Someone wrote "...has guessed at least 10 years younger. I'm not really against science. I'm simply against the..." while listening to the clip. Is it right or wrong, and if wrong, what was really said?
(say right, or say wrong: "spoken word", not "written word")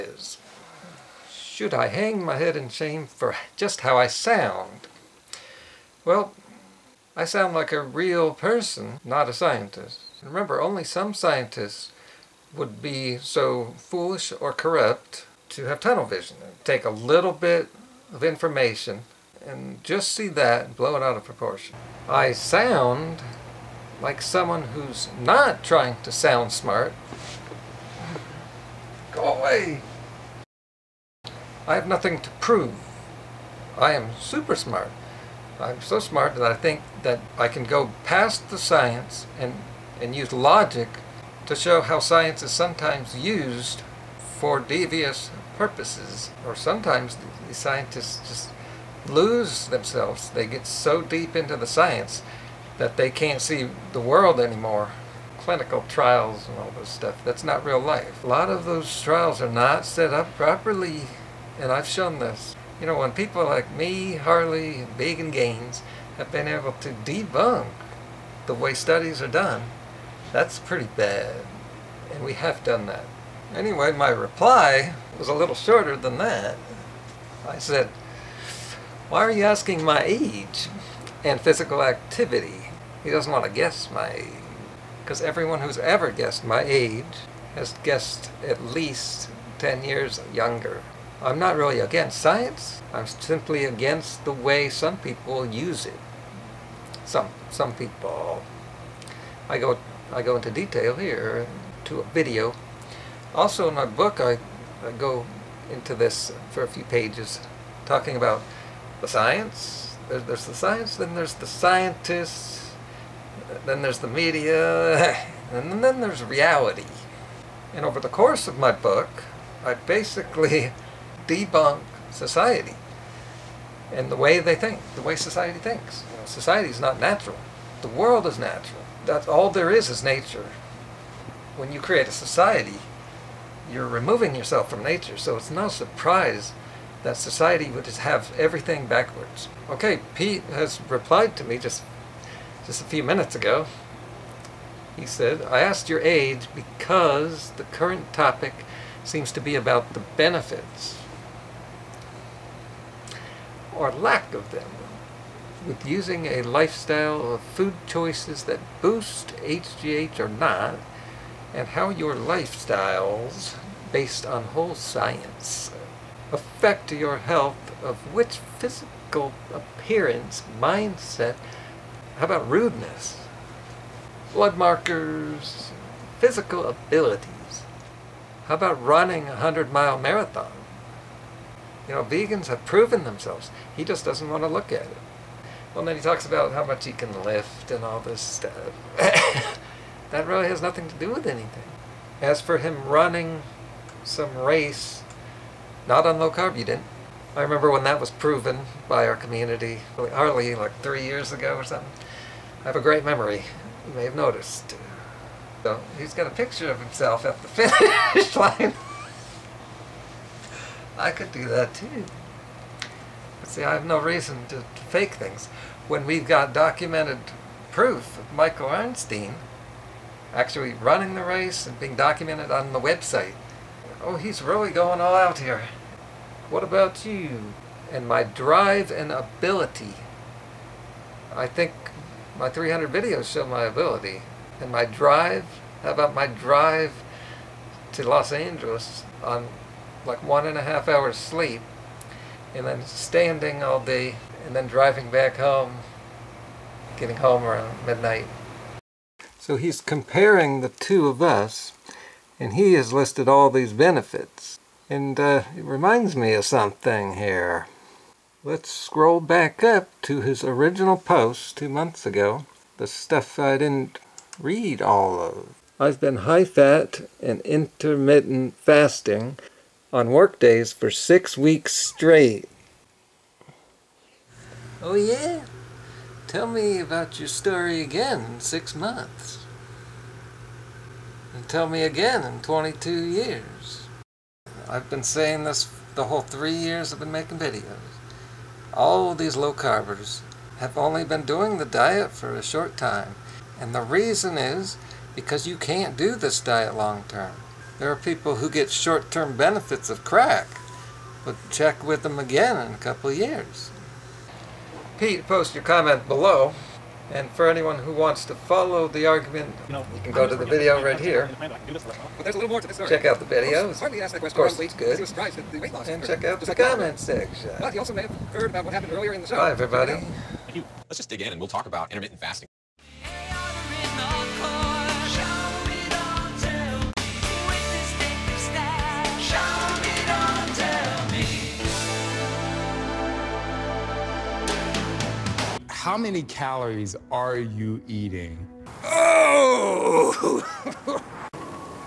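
right.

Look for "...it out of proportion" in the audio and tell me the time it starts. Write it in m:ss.
0:20.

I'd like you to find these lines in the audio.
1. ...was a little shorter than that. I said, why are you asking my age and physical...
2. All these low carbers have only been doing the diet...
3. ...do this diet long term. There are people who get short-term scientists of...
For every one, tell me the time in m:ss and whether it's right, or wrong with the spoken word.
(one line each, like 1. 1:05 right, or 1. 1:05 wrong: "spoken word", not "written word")
1. 1:15 right
2. 4:48 right
3. 4:55 wrong: "benefits", not "scientists".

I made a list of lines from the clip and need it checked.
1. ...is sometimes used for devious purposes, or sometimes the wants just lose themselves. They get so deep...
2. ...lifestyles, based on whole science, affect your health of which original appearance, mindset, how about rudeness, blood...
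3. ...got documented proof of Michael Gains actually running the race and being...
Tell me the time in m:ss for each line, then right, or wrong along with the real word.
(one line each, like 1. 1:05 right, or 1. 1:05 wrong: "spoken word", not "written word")
1. 0:42 wrong: "scientists", not "wants"
2. 2:42 wrong: "physical", not "original"
3. 3:36 wrong: "Arnstein", not "Gains".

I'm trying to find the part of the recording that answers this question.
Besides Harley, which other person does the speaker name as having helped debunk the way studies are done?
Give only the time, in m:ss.
1:04.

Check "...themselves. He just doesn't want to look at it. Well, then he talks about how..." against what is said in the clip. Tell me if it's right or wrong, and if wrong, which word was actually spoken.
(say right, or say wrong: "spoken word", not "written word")
right.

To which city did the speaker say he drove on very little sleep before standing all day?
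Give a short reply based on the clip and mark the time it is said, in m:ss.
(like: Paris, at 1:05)
Los Angeles, at 3:58.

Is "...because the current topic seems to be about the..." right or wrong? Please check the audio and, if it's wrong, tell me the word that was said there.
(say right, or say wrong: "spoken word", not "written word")
right.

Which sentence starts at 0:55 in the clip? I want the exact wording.
Clinical trials and all this stuff, that's not real life.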